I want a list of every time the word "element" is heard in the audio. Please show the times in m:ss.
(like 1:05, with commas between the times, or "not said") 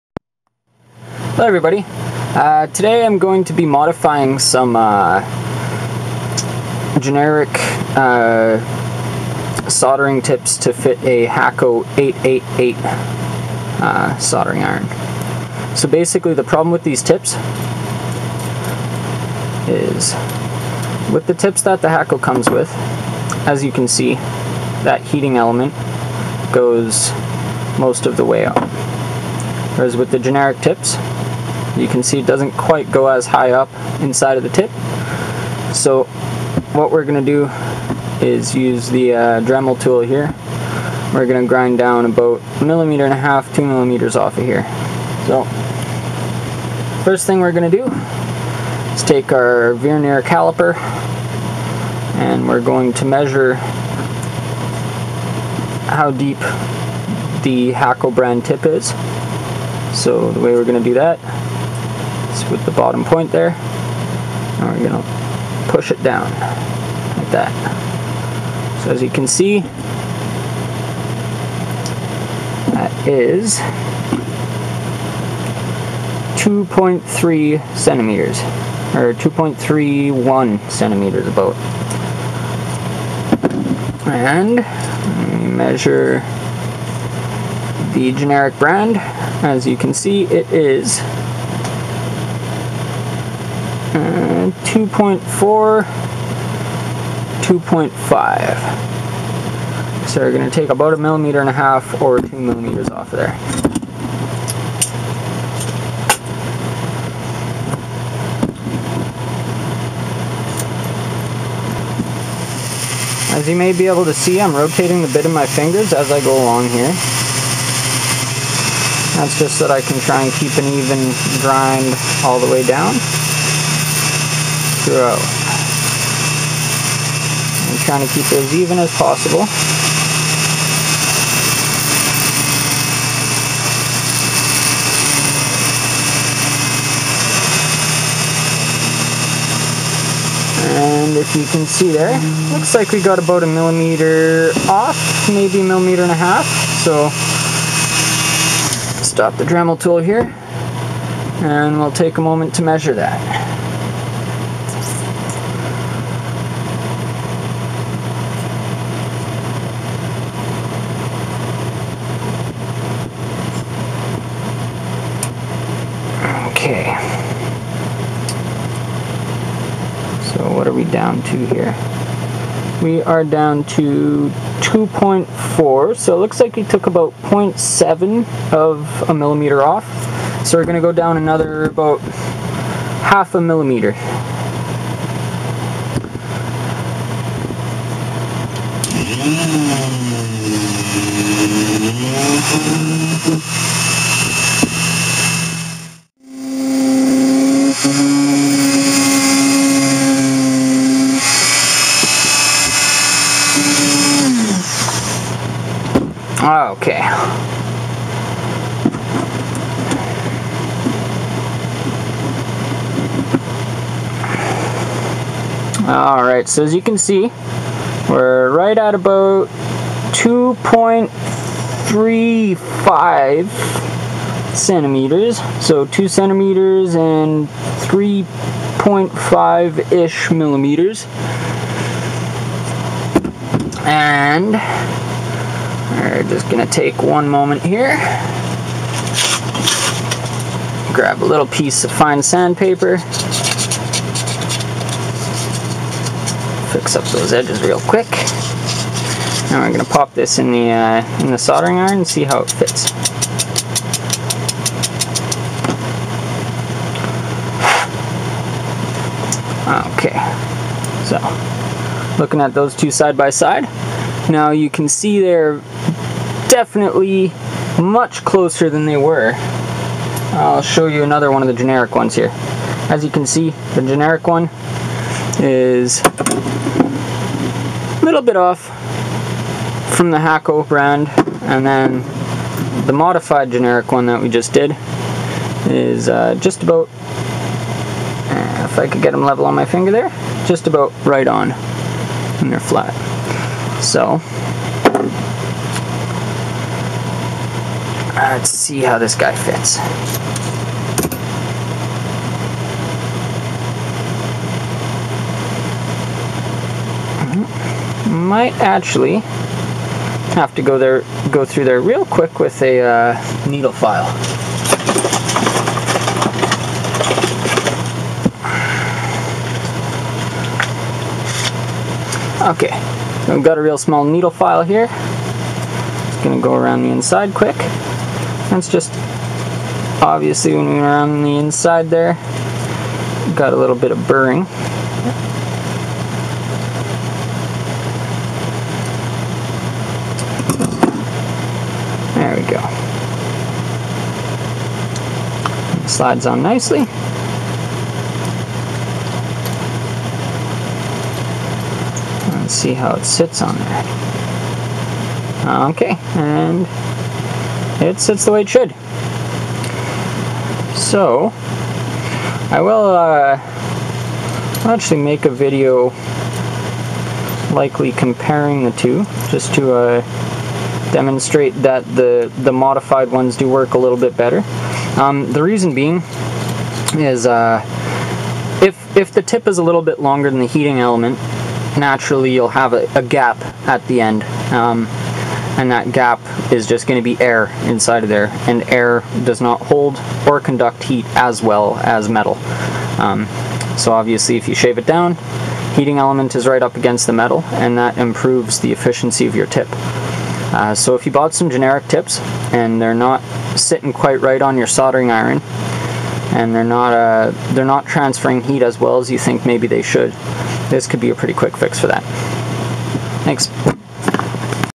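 0:25, 6:20, 6:35.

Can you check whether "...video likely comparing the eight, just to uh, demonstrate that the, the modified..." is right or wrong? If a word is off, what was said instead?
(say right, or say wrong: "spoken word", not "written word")
wrong: "two", not "eight".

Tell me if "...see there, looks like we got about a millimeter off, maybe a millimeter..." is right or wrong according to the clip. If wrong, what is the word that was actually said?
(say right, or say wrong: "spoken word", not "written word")
right.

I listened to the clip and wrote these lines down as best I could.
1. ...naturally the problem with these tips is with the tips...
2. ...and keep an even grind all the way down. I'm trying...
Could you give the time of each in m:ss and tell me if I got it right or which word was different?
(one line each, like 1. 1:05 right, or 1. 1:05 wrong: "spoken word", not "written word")
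1. 0:15 wrong: "basically", not "naturally"
2. 2:00 right.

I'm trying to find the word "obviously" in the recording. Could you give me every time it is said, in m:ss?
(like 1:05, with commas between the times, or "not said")
5:30, 6:33.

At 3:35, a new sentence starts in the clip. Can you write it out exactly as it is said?
Alright, so as you can see, we're right at about 2.35 centimeters.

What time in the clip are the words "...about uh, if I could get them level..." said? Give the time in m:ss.
4:46.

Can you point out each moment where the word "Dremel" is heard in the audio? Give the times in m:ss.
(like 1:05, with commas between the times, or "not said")
0:39, 2:29.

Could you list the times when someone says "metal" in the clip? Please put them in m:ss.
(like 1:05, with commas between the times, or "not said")
6:32, 6:37.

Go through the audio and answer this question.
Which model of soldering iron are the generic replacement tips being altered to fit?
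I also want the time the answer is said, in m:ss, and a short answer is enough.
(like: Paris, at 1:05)
Hakko 888, at 0:11.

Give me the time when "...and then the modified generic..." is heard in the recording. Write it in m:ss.
4:41.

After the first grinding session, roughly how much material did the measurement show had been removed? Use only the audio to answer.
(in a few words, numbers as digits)
0.7 of a millimeter.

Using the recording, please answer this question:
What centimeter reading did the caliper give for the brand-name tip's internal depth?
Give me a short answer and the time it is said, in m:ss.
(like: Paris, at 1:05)
2.31 centimeters, at 1:19.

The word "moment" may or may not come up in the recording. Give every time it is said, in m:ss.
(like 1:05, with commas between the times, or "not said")
2:32, 3:57.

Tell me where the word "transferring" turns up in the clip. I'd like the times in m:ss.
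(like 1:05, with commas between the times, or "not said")
6:47.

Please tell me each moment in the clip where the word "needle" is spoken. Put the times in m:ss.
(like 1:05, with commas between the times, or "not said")
5:13, 5:24.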